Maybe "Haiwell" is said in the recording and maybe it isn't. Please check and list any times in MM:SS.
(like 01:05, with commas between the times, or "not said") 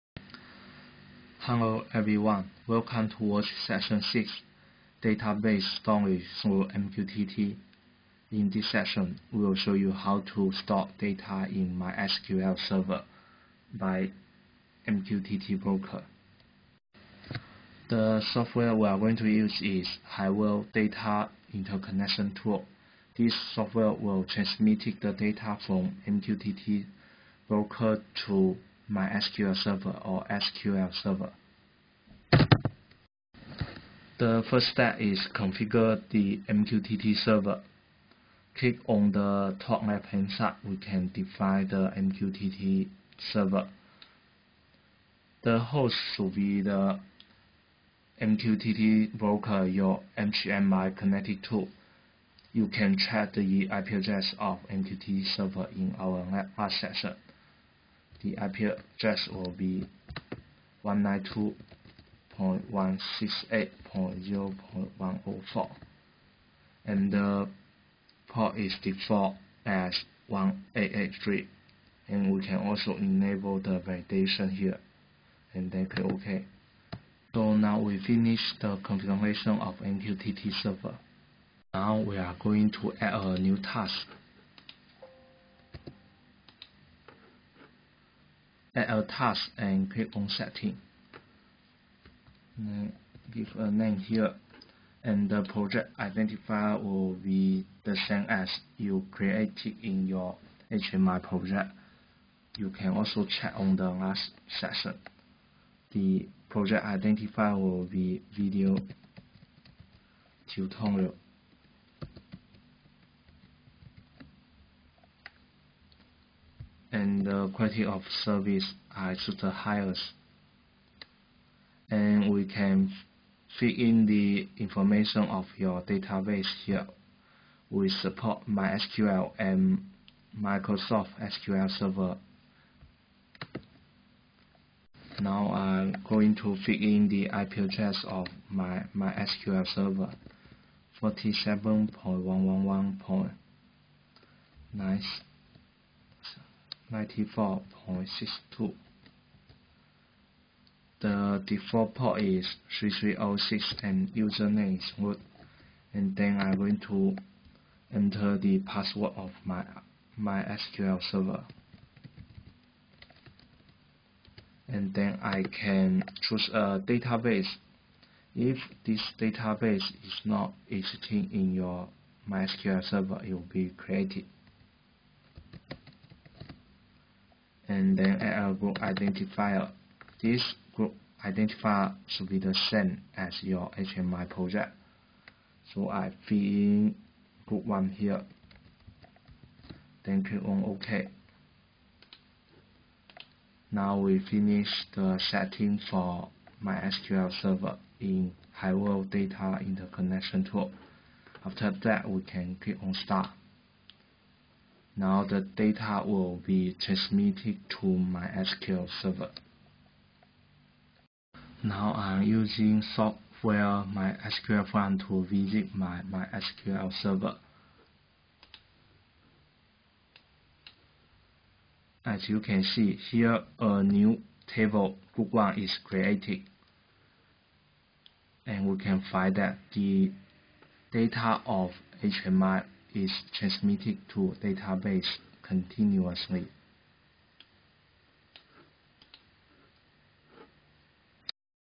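00:20, 03:18.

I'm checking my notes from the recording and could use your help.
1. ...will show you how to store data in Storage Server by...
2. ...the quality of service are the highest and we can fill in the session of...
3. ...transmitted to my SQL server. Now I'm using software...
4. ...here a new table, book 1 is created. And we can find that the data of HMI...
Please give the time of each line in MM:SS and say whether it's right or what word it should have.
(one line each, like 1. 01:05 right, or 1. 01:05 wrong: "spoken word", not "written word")
1. 00:09 wrong: "MySQL", not "Storage"
2. 01:57 wrong: "information", not "session"
3. 03:26 right
4. 03:43 right.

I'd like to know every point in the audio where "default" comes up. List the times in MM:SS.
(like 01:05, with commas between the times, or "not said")
01:08, 02:31.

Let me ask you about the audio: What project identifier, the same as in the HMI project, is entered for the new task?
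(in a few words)
video tutorial.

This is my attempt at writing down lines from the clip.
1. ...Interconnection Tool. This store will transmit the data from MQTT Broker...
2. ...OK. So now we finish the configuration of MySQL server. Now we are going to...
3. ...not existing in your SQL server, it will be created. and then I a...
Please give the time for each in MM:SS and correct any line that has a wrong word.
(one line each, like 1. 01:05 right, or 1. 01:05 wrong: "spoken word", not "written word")
1. 00:21 wrong: "software", not "store"
2. 01:16 wrong: "MQTT", not "MySQL"
3. 02:50 wrong: "MySQL", not "SQL".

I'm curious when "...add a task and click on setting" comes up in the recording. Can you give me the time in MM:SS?
01:28.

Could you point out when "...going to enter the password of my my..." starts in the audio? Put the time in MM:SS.
02:36.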